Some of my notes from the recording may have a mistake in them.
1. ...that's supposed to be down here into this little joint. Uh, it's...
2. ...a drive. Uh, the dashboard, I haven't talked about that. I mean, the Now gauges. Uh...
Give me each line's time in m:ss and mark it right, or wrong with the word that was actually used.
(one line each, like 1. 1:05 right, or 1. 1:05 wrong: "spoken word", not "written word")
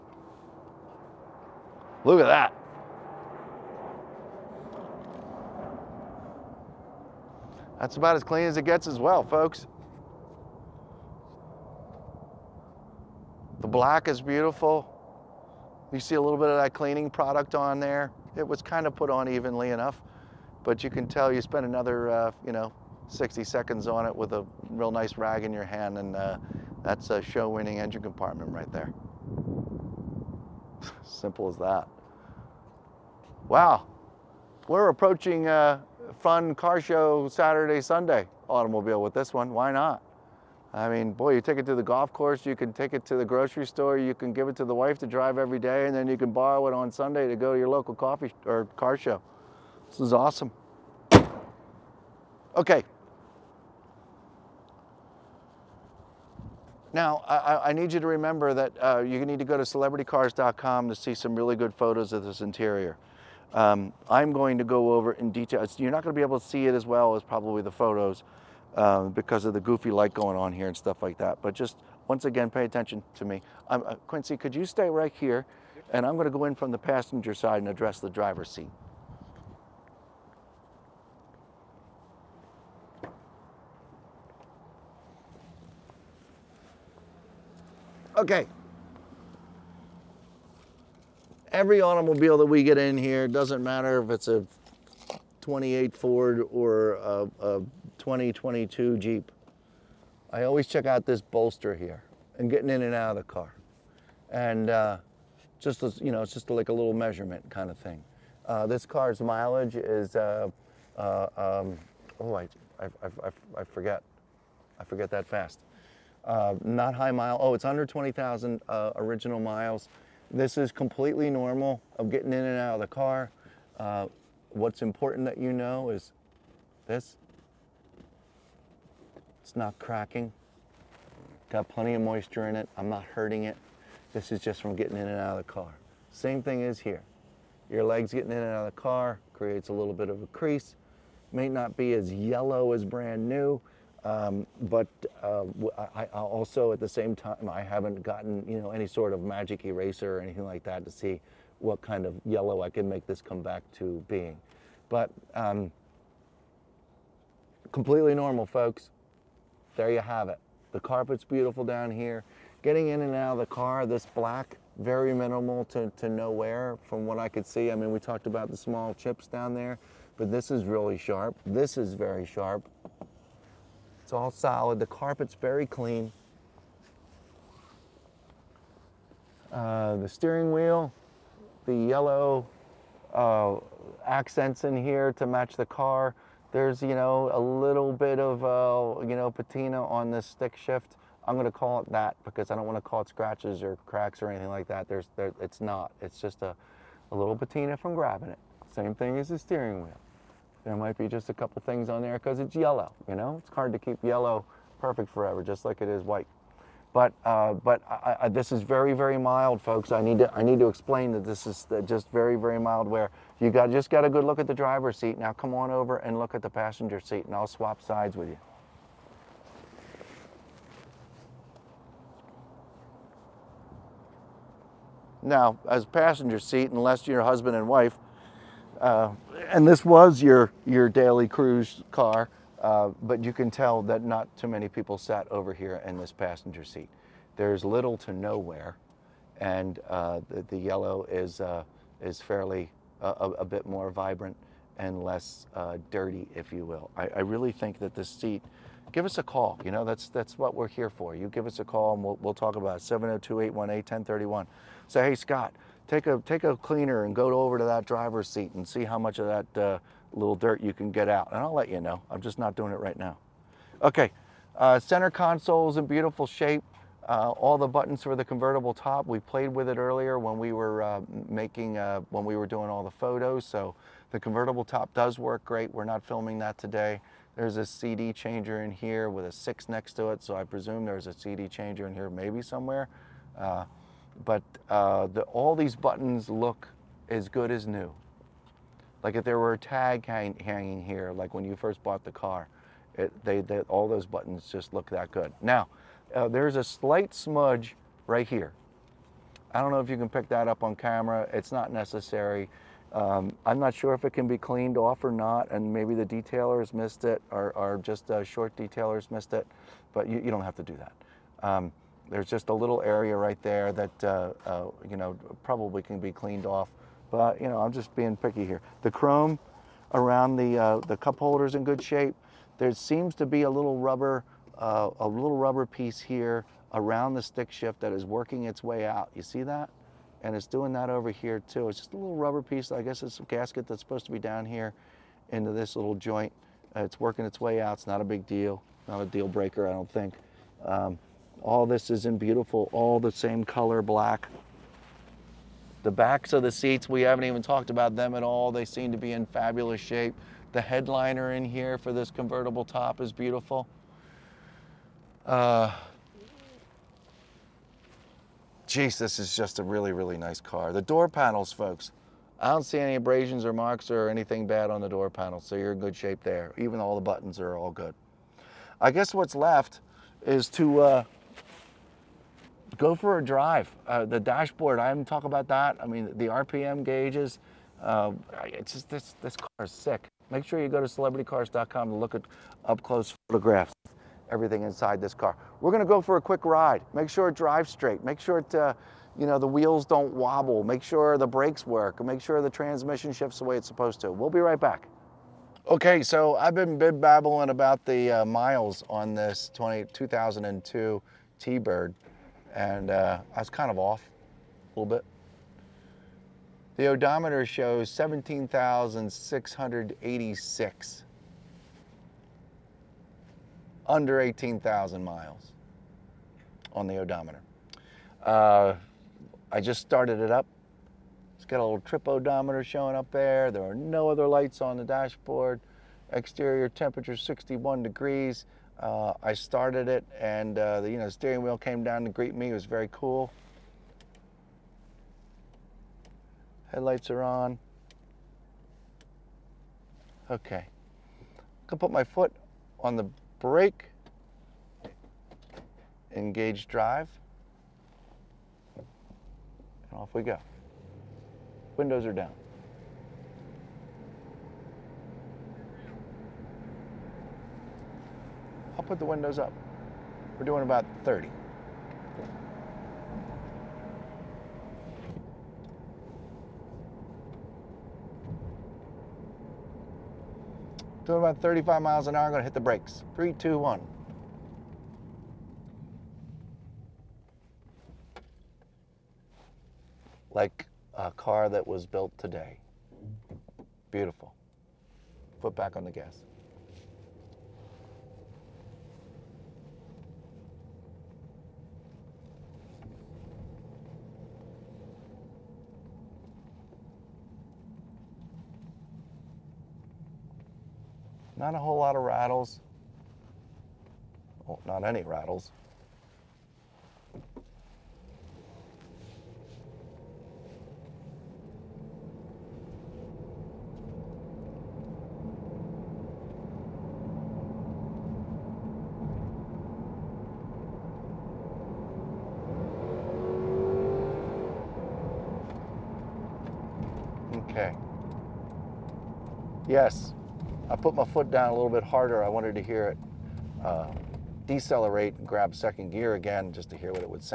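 1. 5:33 right
2. 6:13 wrong: "RPM", not "Now".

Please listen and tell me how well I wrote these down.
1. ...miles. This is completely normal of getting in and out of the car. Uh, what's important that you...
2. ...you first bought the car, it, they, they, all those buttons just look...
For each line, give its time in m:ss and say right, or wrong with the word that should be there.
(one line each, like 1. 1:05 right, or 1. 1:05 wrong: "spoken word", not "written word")
1. 1:59 right
2. 4:51 right.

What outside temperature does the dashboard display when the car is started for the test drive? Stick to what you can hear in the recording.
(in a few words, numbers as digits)
61 degrees.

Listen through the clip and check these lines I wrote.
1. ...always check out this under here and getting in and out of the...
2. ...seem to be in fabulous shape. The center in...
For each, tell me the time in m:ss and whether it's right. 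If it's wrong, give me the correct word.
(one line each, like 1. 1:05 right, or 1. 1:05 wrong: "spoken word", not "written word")
1. 1:40 wrong: "bolster", not "under"
2. 5:48 wrong: "headliner", not "center".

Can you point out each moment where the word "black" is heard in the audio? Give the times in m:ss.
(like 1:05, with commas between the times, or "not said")
0:13, 2:44, 5:43.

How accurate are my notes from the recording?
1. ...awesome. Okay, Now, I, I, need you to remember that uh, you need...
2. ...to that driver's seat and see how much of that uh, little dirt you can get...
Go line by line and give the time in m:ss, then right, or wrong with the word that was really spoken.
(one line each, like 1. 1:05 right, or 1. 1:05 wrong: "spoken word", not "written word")
1. 0:50 right
2. 4:17 right.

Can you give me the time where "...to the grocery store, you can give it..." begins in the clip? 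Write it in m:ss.
0:43.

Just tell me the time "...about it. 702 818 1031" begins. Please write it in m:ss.
4:12.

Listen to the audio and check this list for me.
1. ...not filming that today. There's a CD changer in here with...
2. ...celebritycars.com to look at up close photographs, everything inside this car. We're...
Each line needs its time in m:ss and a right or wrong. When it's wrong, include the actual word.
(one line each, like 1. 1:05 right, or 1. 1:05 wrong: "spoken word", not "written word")
1. 4:35 right
2. 6:20 right.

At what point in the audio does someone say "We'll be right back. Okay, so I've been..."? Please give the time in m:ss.
6:34.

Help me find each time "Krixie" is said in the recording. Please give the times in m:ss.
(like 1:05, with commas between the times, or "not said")
not said.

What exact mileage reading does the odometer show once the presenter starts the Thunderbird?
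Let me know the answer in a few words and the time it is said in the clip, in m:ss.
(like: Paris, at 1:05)
17,686, at 6:47.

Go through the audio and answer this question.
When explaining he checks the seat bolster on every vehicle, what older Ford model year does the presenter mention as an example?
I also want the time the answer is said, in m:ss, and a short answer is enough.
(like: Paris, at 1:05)
28, at 1:35.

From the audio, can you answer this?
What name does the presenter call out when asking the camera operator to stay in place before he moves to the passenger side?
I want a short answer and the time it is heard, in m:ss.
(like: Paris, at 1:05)
Quincy, at 1:14.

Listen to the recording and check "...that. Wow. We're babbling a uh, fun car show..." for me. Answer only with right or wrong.
wrong.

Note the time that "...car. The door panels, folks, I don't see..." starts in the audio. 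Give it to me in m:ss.
6:00.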